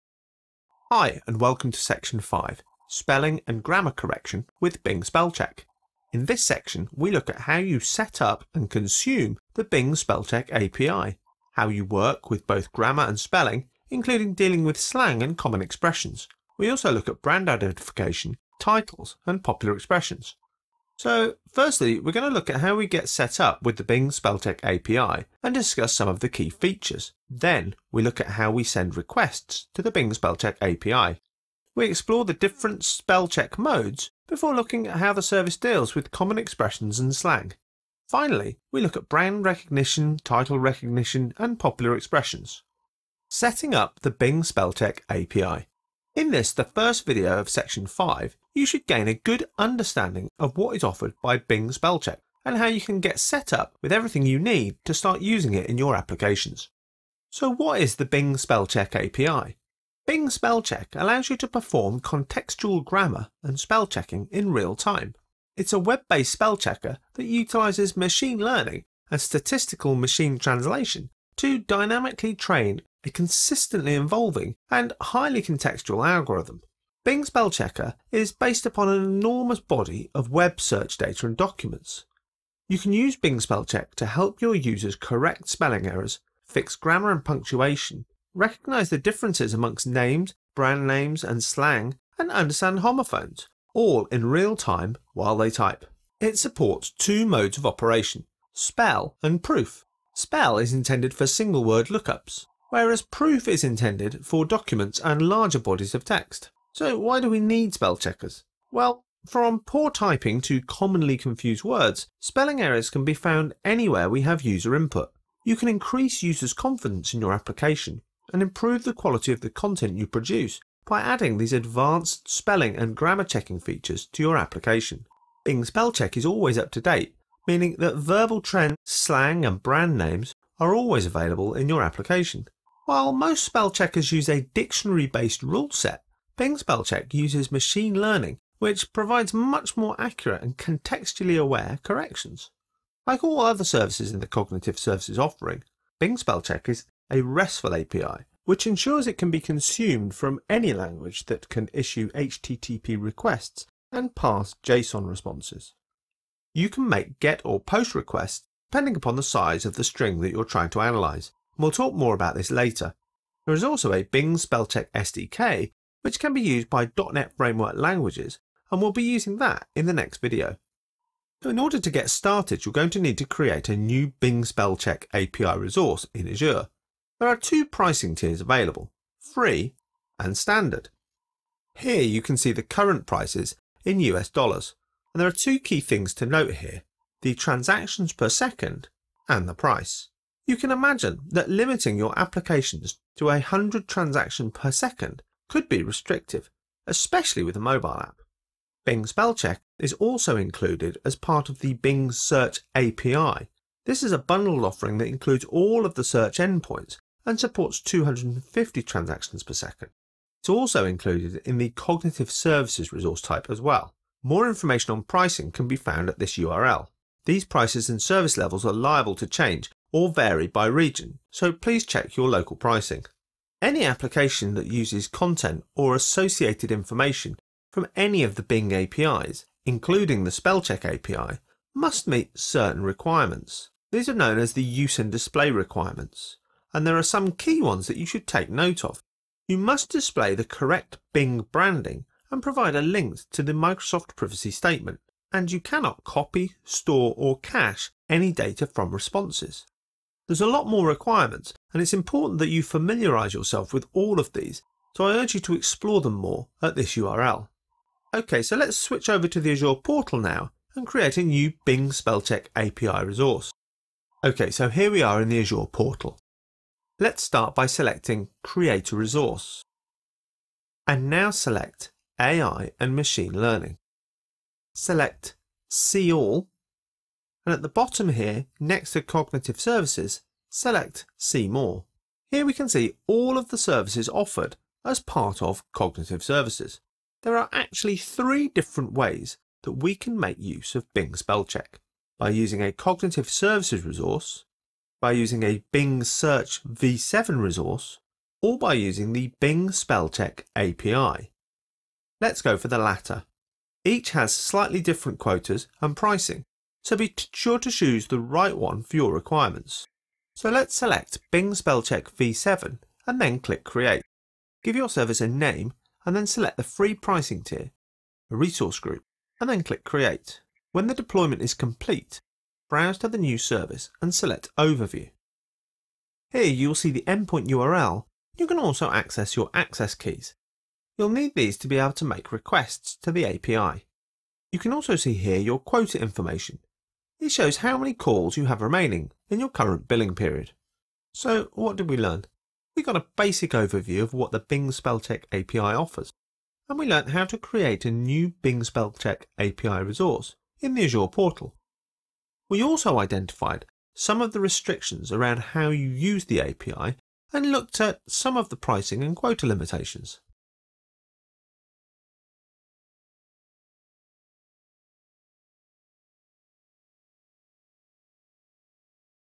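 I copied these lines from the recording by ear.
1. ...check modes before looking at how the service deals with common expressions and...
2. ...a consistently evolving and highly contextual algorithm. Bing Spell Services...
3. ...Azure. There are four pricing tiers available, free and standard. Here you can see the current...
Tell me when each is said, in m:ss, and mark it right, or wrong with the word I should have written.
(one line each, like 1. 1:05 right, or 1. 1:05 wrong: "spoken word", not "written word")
1. 0:33 right
2. 1:13 wrong: "Checker", not "Services"
3. 2:56 wrong: "two", not "four".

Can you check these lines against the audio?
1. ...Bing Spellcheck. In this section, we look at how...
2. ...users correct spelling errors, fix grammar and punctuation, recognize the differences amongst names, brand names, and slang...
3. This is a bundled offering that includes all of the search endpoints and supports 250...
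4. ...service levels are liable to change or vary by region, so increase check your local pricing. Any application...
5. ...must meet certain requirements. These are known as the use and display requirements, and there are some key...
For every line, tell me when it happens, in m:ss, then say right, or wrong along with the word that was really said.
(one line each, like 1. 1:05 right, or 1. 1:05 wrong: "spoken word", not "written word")
1. 0:04 right
2. 1:24 right
3. 3:23 right
4. 3:38 wrong: "please", not "increase"
5. 3:51 right.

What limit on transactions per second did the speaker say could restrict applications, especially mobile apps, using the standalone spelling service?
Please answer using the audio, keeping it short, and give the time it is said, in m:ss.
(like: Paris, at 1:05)
100, at 3:13.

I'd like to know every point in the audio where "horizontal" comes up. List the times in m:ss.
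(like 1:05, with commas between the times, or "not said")
not said.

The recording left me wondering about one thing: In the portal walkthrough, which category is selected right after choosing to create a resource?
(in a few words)
AI and Machine Learning.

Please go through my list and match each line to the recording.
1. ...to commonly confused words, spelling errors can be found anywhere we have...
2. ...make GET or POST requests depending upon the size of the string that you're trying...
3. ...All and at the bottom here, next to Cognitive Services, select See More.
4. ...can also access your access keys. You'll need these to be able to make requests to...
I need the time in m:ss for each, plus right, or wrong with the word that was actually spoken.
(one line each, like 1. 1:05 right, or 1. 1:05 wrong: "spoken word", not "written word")
1. 1:50 right
2. 2:36 right
3. 4:36 right
4. 5:28 right.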